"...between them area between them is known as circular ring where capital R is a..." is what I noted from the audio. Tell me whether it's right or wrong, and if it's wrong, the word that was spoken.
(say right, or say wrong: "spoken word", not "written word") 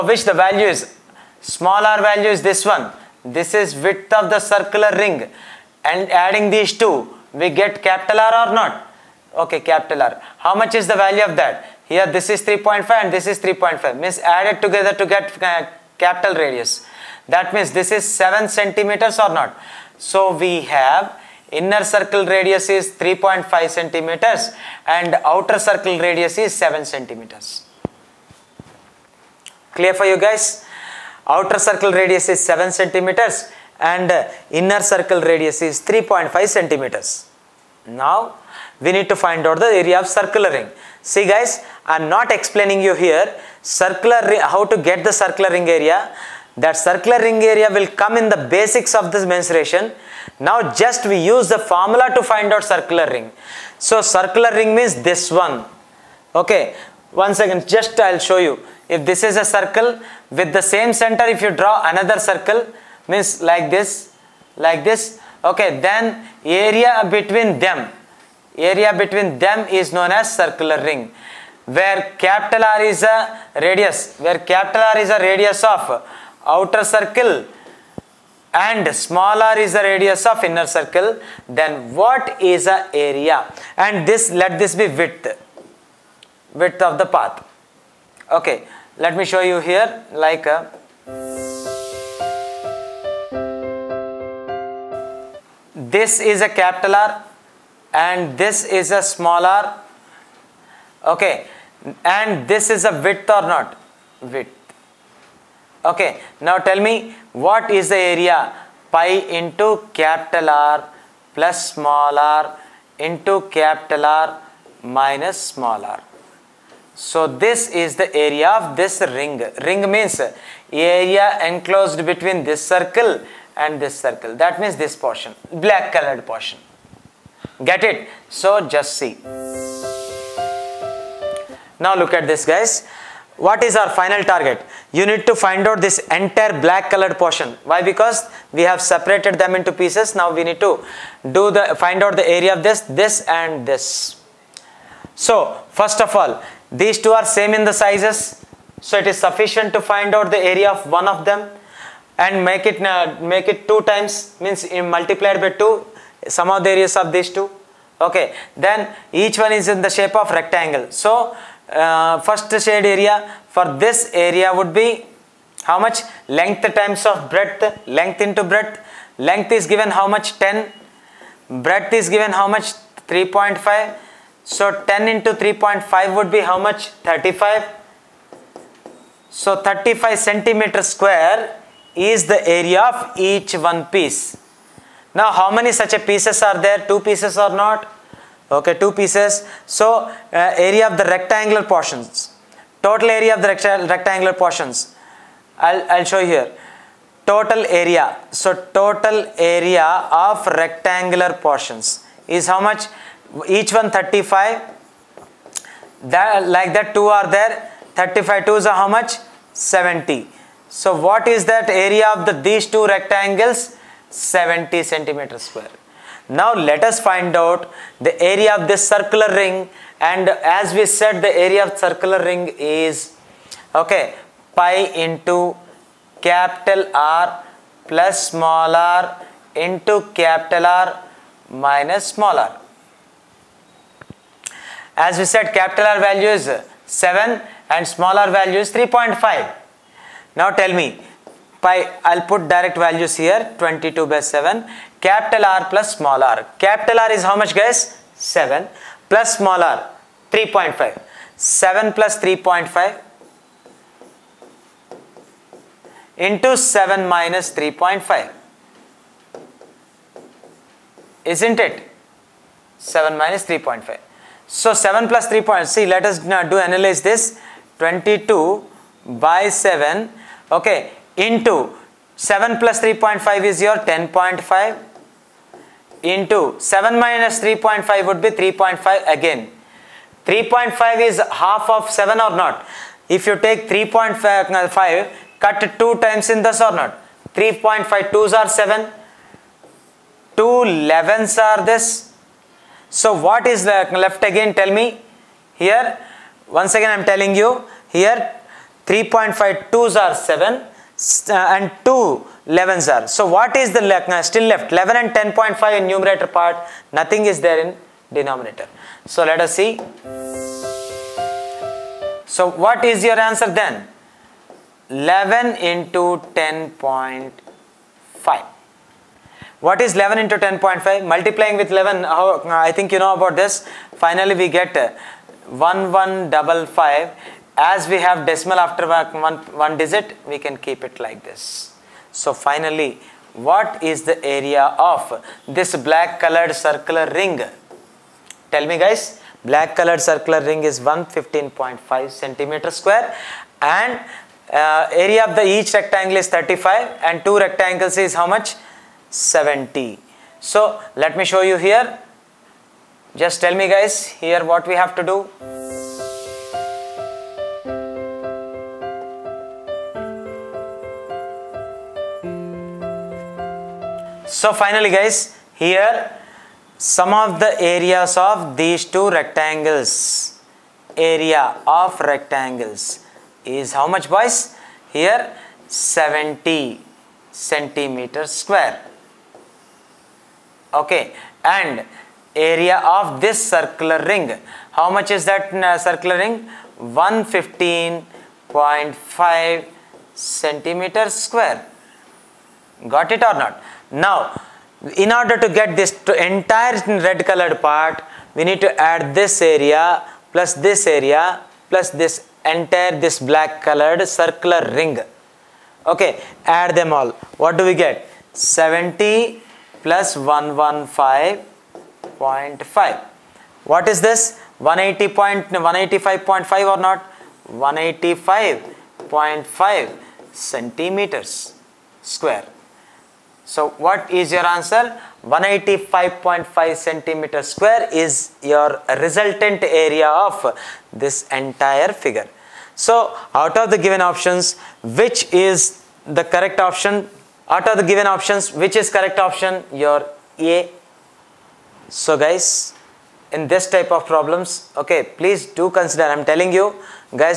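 right.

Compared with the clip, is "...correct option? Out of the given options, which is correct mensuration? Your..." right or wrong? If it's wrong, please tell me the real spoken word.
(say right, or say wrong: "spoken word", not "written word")
wrong: "option", not "mensuration".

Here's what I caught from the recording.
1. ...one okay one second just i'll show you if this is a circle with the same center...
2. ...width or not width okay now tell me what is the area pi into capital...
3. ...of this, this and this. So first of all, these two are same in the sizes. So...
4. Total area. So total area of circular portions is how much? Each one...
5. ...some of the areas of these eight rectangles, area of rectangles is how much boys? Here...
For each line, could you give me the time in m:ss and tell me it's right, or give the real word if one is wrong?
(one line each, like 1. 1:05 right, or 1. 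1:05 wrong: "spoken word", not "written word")
1. 0:55 right
2. 1:43 right
3. 2:22 right
4. 3:17 wrong: "rectangular", not "circular"
5. 6:06 wrong: "two", not "eight".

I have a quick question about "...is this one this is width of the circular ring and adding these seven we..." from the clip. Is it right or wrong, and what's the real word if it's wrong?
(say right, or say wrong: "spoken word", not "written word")
wrong: "two", not "seven".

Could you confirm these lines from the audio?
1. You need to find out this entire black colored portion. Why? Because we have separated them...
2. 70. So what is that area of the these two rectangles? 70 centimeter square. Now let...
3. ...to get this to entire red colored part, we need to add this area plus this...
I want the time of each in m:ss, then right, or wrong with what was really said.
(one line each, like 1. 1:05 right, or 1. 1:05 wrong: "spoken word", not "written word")
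1. 2:14 right
2. 3:29 right
3. 6:35 right.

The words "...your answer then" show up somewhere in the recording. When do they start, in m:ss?
5:13.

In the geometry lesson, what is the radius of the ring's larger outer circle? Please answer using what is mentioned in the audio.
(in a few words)
7 centimeters.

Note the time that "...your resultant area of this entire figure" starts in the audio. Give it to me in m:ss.
7:08.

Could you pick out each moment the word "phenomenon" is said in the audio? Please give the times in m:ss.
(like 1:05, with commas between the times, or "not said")
not said.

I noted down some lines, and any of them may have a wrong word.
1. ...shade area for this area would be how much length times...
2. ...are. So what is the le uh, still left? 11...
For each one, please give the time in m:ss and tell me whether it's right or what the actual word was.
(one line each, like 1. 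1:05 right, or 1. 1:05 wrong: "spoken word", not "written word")
1. 2:42 right
2. 5:02 right.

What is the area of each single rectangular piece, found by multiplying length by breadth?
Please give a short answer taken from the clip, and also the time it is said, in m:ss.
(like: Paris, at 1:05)
35 square centimeters, at 2:59.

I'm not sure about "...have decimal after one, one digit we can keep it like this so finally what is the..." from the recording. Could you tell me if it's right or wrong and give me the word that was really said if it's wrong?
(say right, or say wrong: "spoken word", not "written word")
right.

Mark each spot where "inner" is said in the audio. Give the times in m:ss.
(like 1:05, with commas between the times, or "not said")
0:21, 0:34, 1:20.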